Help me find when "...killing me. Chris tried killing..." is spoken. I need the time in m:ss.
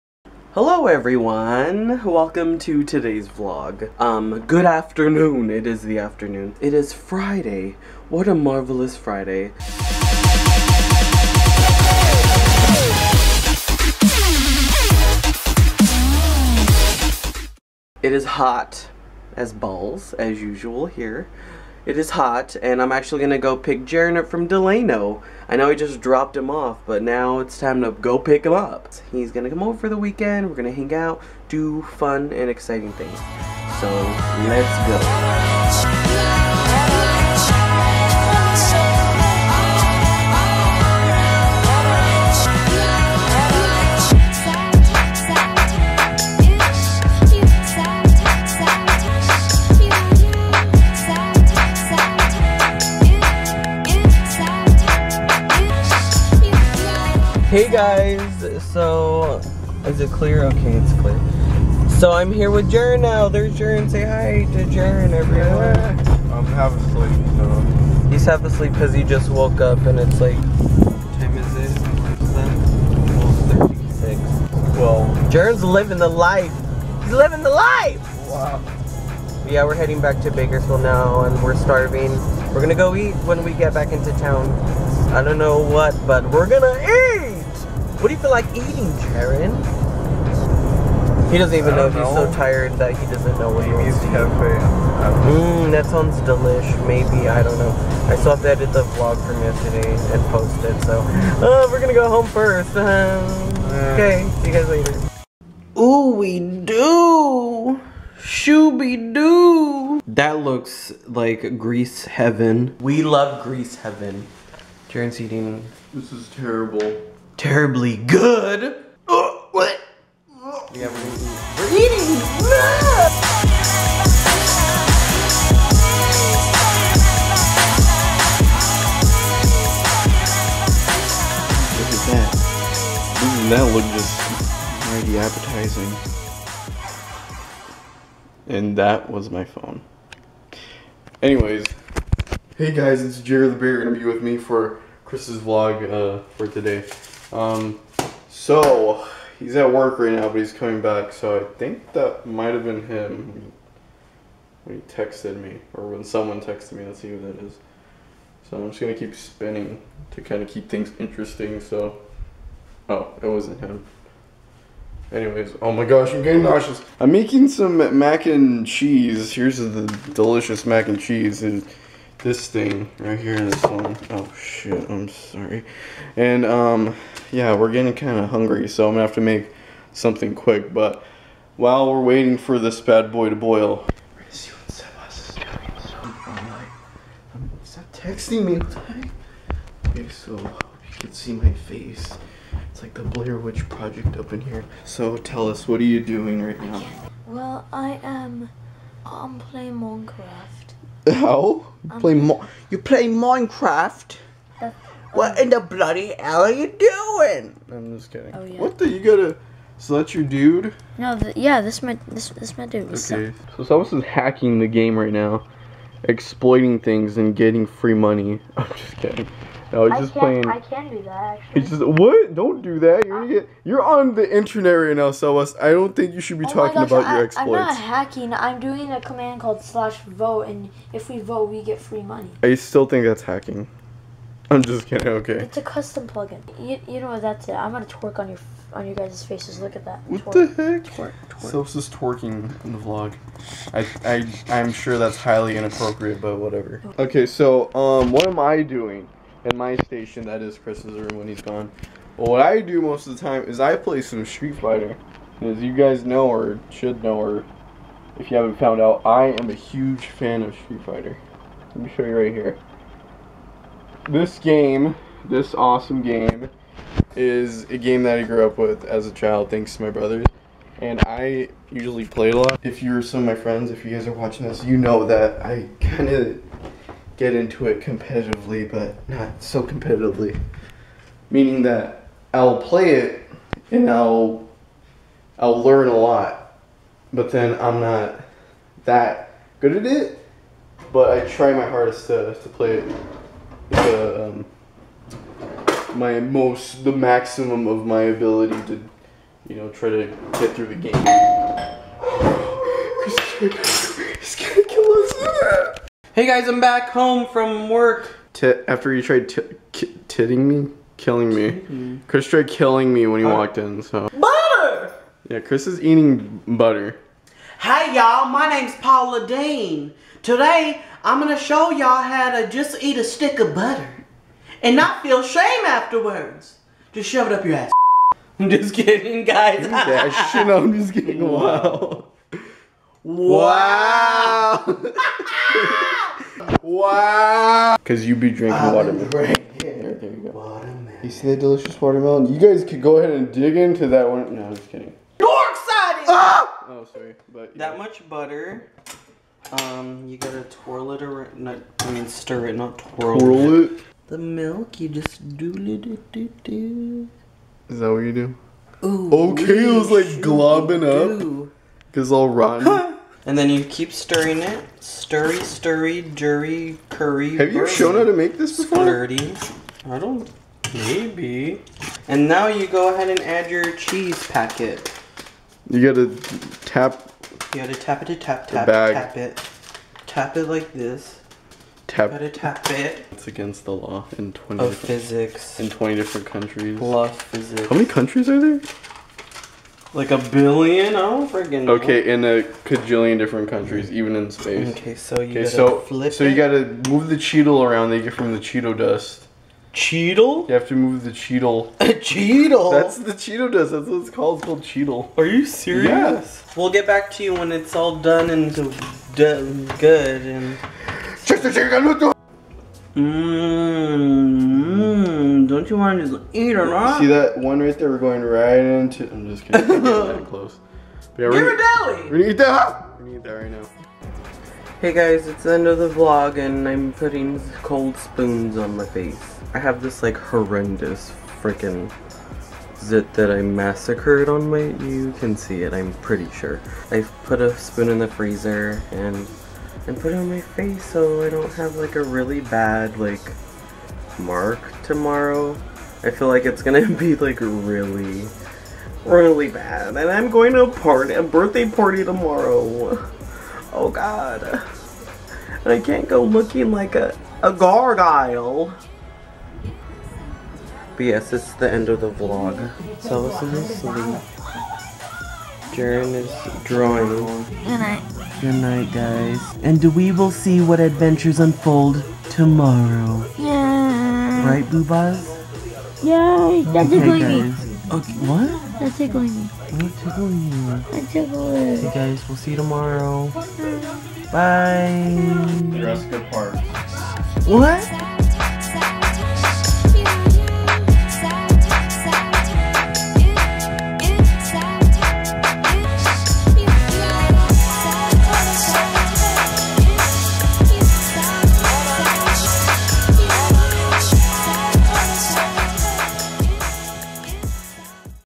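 5:10.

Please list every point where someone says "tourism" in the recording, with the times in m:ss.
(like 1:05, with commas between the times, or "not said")
not said.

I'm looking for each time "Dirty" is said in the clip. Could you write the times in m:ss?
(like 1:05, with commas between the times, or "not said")
6:08.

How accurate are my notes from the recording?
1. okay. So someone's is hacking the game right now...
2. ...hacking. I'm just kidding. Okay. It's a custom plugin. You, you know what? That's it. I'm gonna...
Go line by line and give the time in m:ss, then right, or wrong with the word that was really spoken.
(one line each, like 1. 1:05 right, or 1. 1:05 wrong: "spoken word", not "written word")
1. 3:33 right
2. 3:53 right.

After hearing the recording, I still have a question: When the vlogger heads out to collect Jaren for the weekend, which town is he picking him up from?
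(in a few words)
Delano.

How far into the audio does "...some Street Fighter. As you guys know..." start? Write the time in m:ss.
4:14.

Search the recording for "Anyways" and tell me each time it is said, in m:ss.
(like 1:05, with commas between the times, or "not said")
2:21, 2:45.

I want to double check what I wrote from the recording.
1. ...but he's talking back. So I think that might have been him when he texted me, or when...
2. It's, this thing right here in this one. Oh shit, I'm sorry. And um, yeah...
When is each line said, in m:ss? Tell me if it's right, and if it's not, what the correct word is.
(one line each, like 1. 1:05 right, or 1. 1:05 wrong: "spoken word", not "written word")
1. 2:30 wrong: "coming", not "talking"
2. 2:51 right.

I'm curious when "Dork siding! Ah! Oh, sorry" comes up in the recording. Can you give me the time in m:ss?
5:45.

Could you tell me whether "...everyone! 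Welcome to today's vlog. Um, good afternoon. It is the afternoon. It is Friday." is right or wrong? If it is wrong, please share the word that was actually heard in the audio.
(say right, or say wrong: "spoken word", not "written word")
right.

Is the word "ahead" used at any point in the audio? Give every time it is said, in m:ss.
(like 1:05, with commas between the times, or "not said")
5:42, 6:12.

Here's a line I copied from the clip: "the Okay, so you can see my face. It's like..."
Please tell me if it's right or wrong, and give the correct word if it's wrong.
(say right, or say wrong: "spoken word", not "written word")
right.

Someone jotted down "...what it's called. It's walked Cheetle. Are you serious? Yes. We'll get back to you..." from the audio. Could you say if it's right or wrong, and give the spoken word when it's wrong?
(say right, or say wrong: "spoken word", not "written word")
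wrong: "called", not "walked".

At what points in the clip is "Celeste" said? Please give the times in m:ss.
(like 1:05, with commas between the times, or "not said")
3:45, 4:01.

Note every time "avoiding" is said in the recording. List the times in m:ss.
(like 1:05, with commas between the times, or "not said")
not said.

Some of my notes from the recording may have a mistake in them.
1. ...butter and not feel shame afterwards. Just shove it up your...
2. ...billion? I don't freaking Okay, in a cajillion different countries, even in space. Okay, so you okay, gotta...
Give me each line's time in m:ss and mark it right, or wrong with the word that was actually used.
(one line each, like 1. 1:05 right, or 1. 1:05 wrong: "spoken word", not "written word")
1. 5:23 right
2. 6:30 right.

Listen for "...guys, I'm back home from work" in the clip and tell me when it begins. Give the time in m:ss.
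5:06.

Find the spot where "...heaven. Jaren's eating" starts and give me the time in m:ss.
1:53.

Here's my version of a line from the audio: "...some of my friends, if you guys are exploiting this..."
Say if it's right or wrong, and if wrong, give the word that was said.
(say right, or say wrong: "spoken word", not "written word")
wrong: "watching", not "exploiting".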